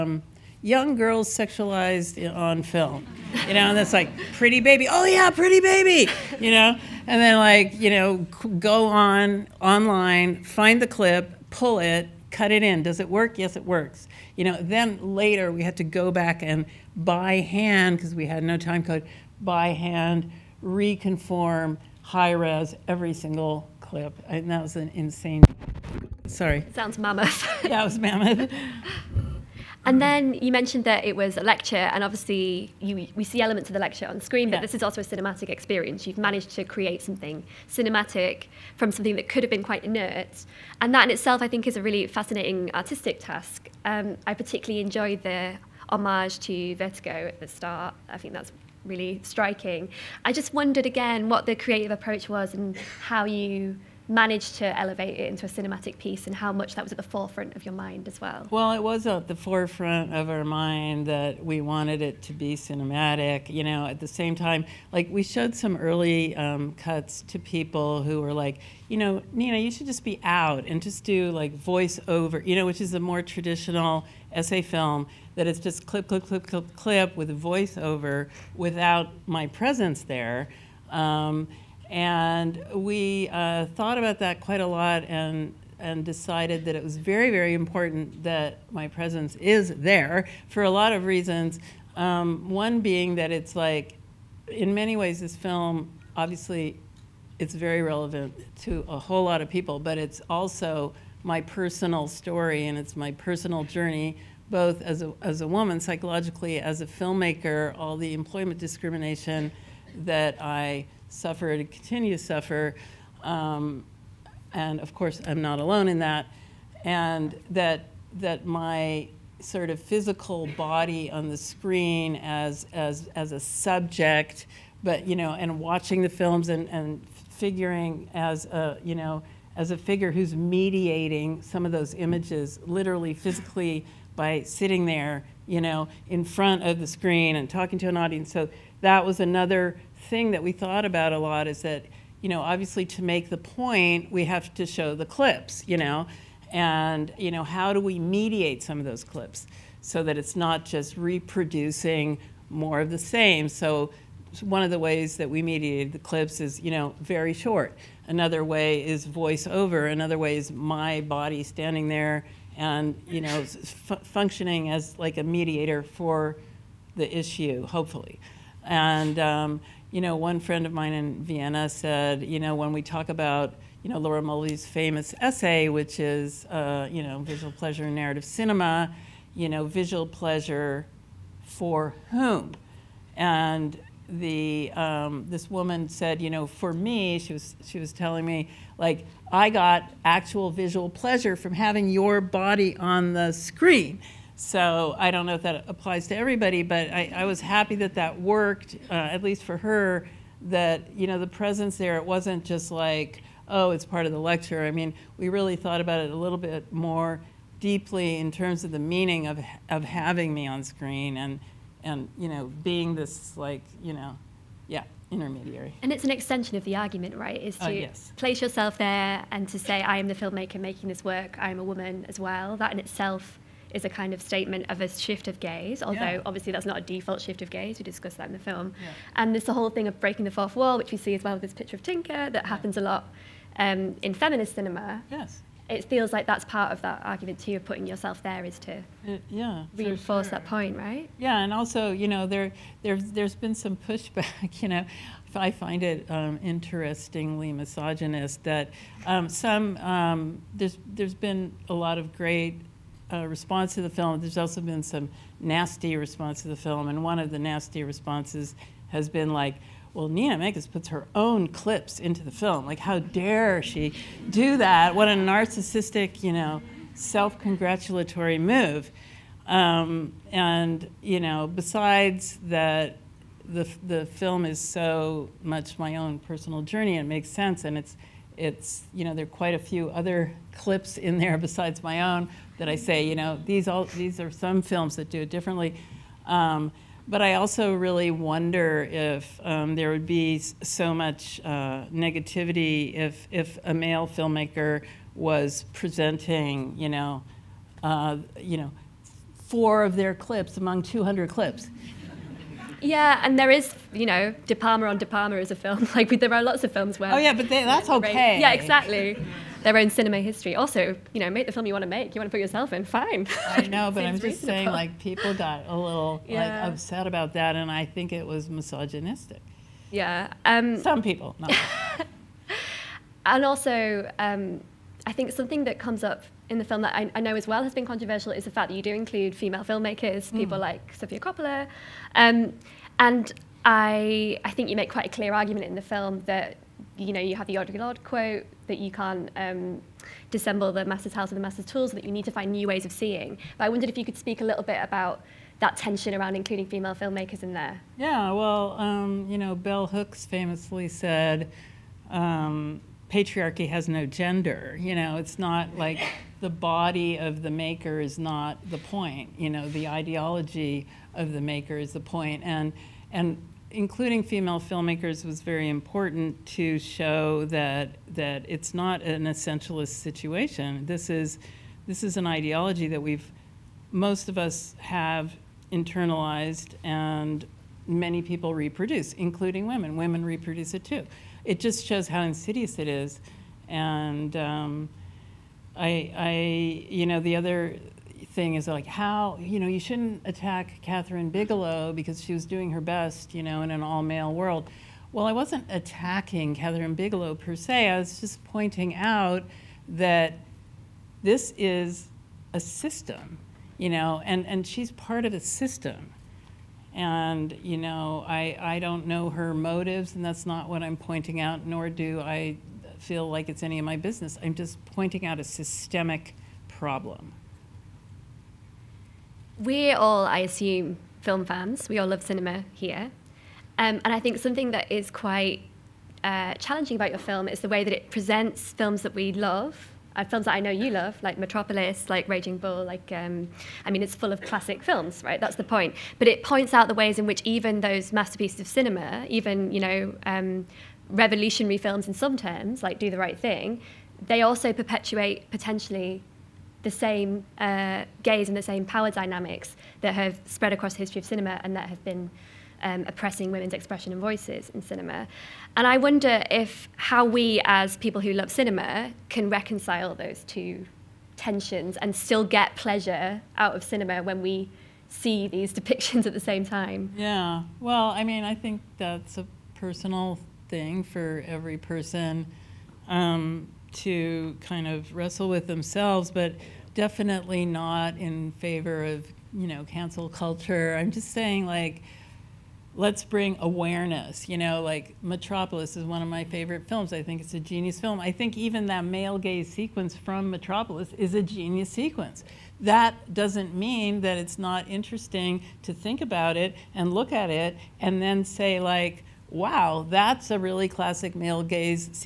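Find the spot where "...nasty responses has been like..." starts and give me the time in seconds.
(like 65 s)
257 s.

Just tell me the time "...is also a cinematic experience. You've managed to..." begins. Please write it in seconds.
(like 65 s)
34 s.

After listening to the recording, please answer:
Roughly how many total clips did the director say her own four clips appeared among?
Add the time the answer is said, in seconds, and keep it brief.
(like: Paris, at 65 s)
200, at 300 s.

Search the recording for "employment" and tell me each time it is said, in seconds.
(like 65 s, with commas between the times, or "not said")
108 s.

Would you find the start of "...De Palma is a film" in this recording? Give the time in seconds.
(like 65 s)
304 s.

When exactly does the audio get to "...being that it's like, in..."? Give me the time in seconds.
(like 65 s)
92 s.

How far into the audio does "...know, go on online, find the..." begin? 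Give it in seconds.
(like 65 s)
7 s.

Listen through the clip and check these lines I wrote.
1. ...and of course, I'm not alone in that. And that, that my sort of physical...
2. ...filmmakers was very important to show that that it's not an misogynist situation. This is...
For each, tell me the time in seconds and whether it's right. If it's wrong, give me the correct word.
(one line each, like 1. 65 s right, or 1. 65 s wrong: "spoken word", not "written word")
1. 114 s right
2. 364 s wrong: "essentialist", not "misogynist".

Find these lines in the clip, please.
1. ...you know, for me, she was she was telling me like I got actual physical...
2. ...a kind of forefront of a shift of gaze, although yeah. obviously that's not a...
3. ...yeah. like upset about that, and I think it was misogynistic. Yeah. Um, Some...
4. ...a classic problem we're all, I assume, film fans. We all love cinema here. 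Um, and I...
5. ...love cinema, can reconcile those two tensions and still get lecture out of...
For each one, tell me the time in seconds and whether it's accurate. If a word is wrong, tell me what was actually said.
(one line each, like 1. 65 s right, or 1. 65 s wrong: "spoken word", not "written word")
1. 186 s wrong: "visual", not "physical"
2. 223 s wrong: "statement", not "forefront"
3. 316 s right
4. 415 s wrong: "systemic", not "classic"
5. 458 s wrong: "pleasure", not "lecture".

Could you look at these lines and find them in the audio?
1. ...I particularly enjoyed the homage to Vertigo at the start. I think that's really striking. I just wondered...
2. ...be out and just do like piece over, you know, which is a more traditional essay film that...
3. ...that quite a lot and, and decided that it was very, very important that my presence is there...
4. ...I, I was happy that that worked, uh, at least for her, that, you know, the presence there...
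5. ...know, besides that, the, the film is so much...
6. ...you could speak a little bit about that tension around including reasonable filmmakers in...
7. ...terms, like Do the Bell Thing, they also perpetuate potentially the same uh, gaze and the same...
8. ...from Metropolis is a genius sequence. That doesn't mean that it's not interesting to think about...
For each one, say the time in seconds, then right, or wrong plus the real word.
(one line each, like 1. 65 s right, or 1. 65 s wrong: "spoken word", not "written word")
1. 44 s right
2. 70 s wrong: "voice", not "piece"
3. 84 s right
4. 196 s right
5. 271 s right
6. 343 s wrong: "female", not "reasonable"
7. 442 s wrong: "Right", not "Bell"
8. 490 s right.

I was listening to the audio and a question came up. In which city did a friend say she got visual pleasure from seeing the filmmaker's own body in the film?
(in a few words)
Vienna.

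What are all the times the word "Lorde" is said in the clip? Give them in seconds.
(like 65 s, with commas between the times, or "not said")
337 s.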